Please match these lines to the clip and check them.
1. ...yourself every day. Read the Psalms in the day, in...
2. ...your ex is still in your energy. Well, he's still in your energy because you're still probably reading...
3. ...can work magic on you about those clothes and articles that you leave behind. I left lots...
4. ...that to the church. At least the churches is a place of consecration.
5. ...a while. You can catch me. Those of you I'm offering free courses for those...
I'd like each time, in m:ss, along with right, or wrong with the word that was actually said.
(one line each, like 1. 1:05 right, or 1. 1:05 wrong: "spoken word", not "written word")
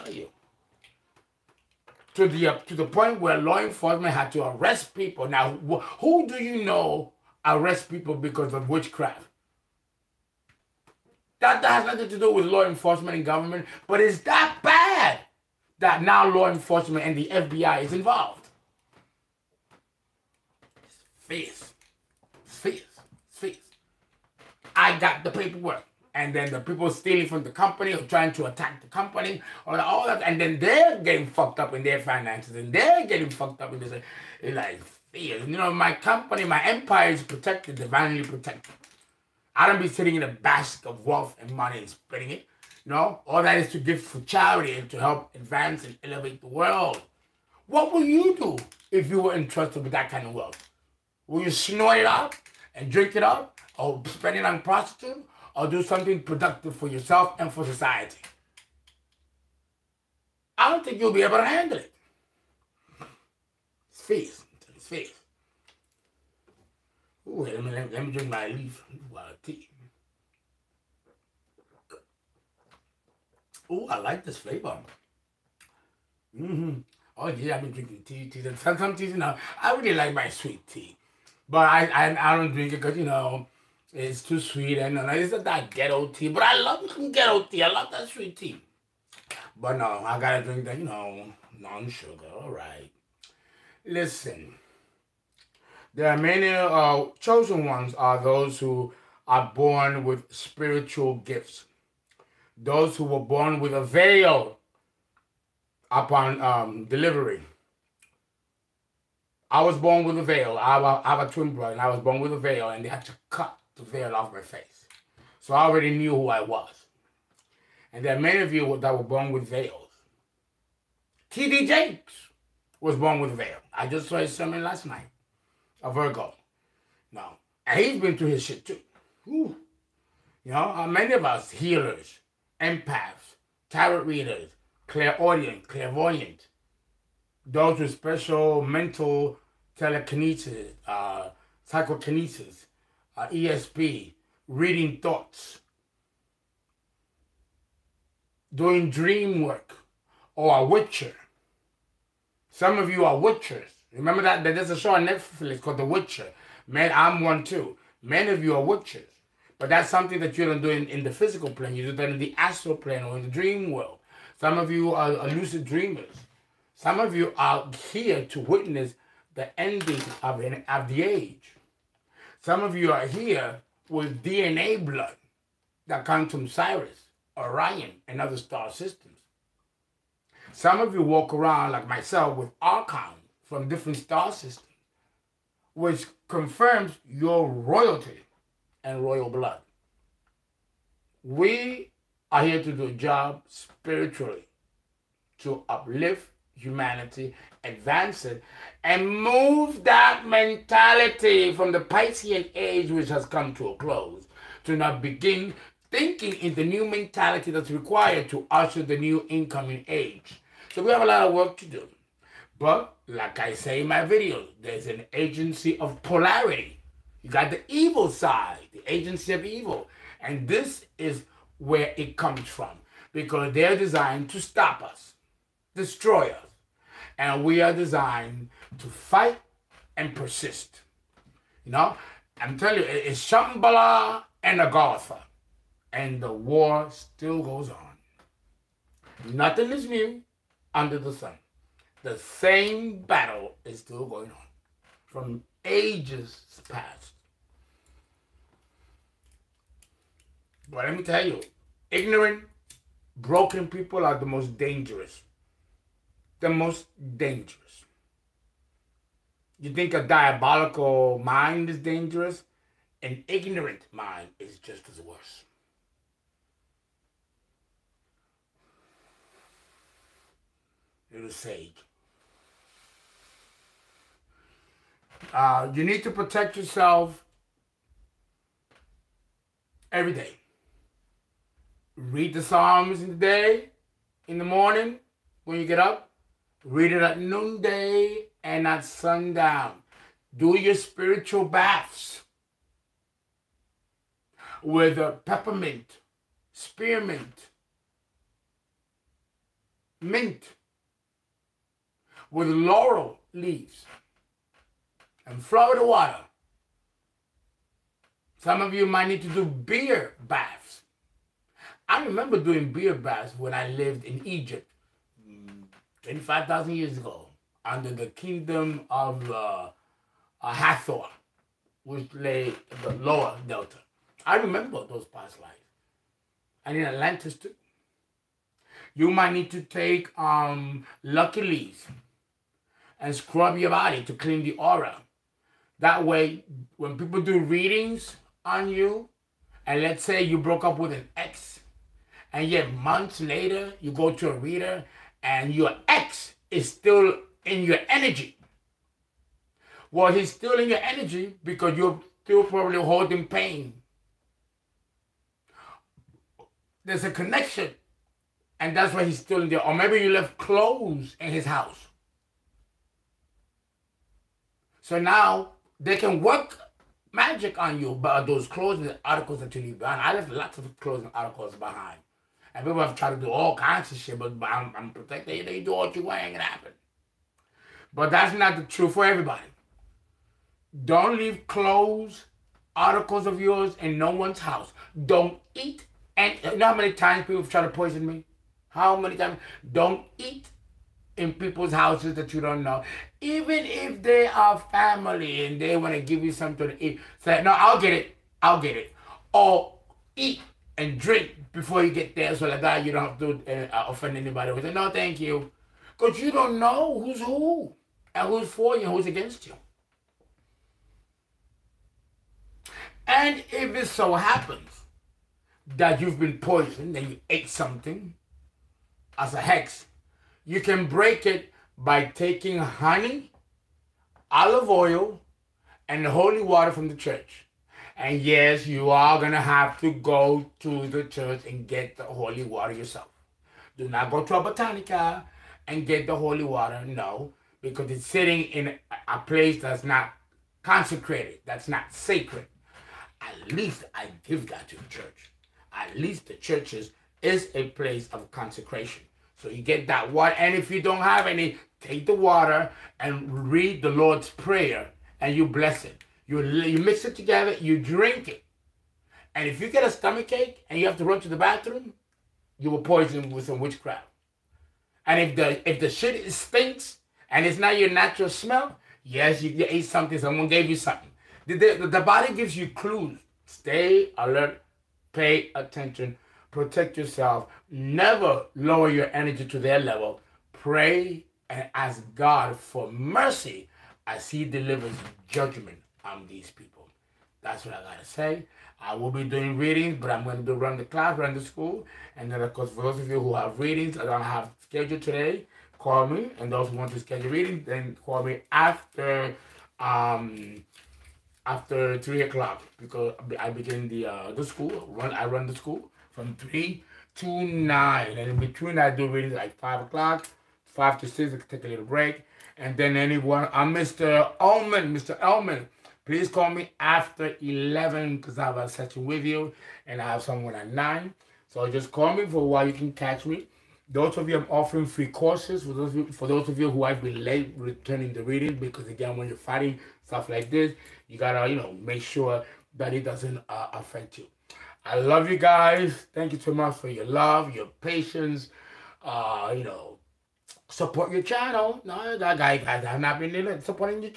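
1. 4:36 right
2. 5:45 wrong: "holding", not "reading"
3. 6:05 right
4. 7:24 right
5. 8:42 right.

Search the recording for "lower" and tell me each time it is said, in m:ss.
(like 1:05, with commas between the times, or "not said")
5:23, 7:58.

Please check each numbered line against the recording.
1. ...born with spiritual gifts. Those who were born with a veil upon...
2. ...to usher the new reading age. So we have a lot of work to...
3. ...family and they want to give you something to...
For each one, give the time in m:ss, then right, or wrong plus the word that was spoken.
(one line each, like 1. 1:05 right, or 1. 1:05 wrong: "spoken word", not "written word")
1. 1:39 right
2. 3:28 wrong: "incoming", not "reading"
3. 6:34 right.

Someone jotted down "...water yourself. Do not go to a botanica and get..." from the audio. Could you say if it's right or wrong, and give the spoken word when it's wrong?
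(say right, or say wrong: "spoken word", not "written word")
right.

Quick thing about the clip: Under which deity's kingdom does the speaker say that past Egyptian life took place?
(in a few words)
Hathor.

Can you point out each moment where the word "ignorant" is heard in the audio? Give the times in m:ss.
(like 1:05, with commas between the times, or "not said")
4:11, 4:23.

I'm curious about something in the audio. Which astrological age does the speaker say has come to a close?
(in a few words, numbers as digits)
Piscean age.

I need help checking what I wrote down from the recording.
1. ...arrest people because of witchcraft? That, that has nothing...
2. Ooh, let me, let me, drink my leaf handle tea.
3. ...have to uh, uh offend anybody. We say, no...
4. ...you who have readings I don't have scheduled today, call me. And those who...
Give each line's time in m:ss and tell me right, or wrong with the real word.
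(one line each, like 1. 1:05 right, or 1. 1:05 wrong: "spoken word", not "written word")
1. 0:07 right
2. 1:07 wrong: "while", not "handle"
3. 6:43 right
4. 8:13 right.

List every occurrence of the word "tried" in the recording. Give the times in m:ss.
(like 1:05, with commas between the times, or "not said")
6:12, 6:27.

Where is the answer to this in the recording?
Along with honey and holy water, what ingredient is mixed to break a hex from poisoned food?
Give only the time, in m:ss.
7:04.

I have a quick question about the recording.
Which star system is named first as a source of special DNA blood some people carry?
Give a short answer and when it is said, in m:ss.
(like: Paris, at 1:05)
Sirius, at 2:56.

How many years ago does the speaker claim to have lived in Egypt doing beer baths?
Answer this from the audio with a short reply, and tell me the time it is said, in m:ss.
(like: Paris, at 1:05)
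25,000, at 5:16.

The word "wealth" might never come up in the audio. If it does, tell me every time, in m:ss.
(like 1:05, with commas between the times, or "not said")
0:41, 0:50.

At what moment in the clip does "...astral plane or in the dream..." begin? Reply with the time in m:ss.
2:42.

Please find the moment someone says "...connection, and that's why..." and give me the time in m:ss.
5:57.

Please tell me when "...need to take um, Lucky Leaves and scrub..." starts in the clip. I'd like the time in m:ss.
5:29.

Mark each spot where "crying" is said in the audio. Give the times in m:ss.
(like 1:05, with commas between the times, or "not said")
not said.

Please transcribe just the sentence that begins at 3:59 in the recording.
Nothing is new under the sun.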